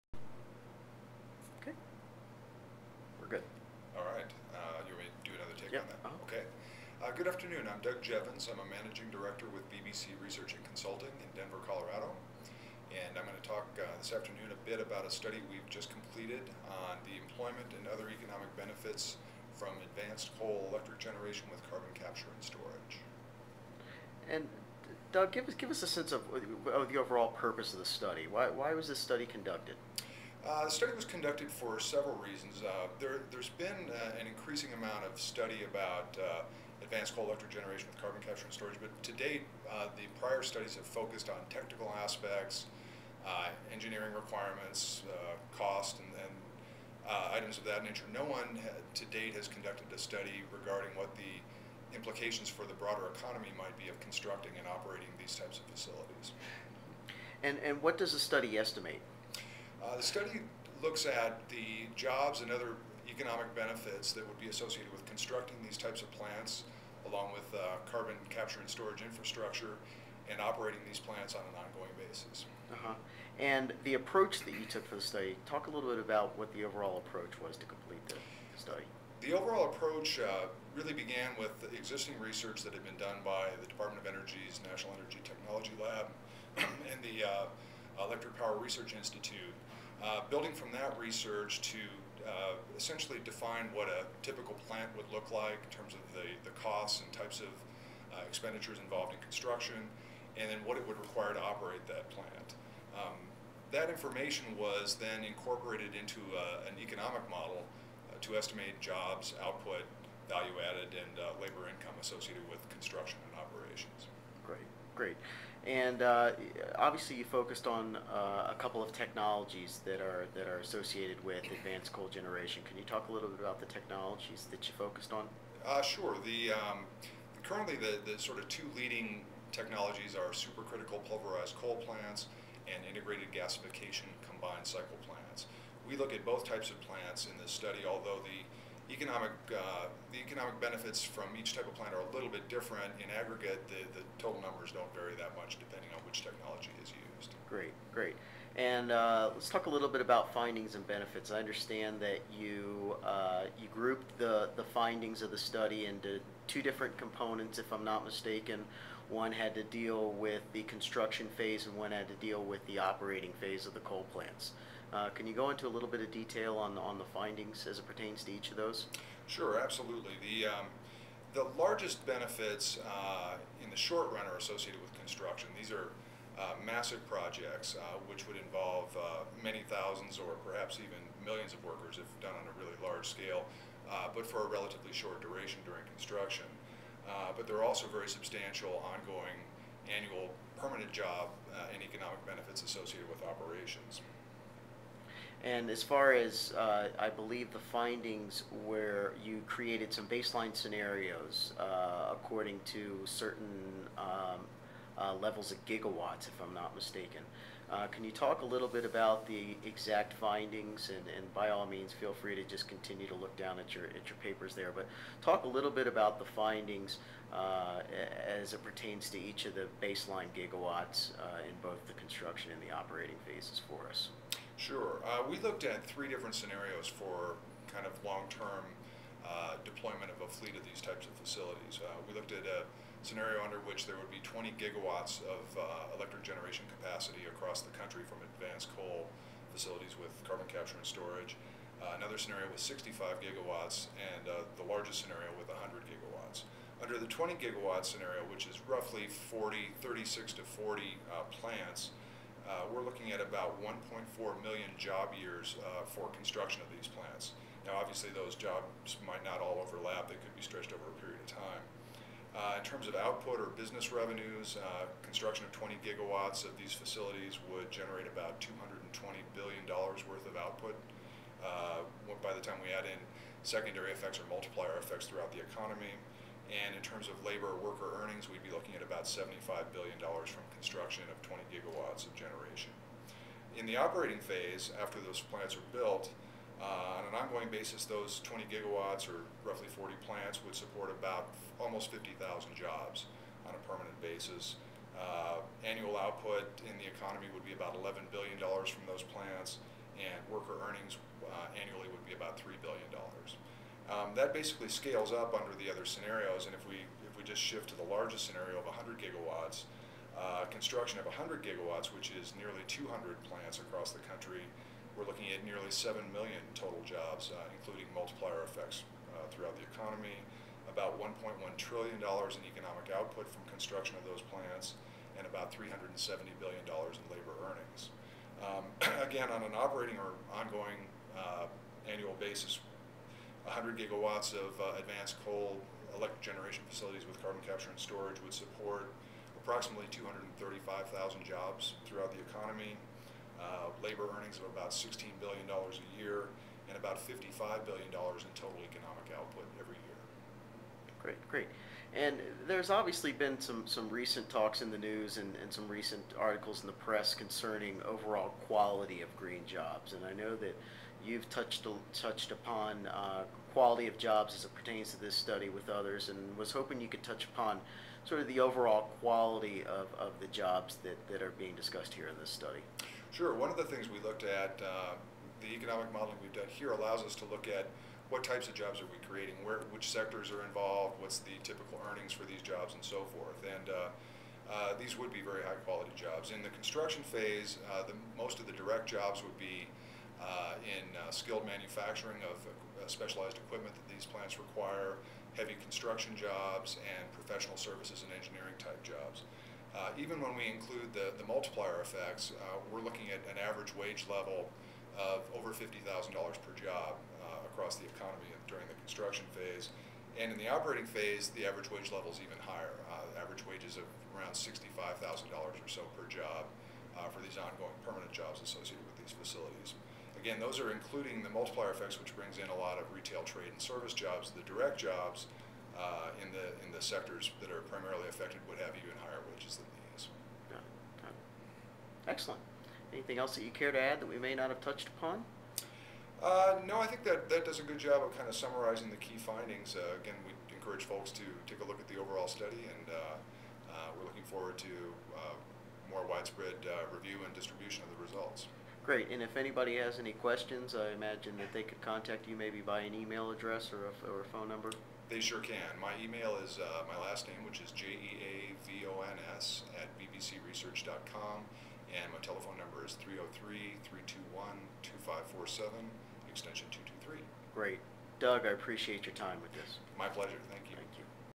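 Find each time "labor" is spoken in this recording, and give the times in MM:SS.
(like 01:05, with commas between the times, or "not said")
01:51, 04:37, 05:27, 05:43.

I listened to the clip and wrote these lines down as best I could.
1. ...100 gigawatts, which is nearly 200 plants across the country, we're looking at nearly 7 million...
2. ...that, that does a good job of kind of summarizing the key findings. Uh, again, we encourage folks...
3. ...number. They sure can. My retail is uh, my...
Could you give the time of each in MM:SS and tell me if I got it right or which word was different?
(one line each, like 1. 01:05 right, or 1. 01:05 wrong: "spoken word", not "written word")
1. 05:11 right
2. 07:17 right
3. 07:34 wrong: "email", not "retail".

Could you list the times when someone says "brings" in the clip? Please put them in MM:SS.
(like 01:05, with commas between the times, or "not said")
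07:02.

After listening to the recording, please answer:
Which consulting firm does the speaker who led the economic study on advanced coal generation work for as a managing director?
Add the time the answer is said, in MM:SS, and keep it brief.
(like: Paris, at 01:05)
BBC Research and Consulting, at 00:09.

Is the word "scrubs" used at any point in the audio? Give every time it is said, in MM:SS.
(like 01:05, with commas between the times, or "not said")
not said.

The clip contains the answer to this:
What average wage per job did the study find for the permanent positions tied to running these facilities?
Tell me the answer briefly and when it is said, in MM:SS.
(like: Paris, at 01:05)
$65,000, at 06:54.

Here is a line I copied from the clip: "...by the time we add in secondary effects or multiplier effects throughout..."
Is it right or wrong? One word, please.
right.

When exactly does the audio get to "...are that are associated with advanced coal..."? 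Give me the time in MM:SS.
02:00.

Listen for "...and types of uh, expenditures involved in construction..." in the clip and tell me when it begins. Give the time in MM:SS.
01:37.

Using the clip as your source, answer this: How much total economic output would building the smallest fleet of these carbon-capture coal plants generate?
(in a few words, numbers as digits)
$220 billion.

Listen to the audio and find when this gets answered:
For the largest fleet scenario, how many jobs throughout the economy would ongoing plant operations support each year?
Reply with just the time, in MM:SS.
05:39.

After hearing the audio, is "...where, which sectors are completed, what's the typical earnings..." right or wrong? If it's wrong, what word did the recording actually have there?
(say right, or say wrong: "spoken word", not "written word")
wrong: "involved", not "completed".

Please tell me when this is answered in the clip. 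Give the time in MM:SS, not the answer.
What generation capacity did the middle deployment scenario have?
04:02.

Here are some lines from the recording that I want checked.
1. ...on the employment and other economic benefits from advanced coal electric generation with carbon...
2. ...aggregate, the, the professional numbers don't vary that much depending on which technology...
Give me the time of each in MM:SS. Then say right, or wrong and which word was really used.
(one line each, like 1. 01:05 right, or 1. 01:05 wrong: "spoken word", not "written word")
1. 00:16 right
2. 02:23 wrong: "total", not "professional".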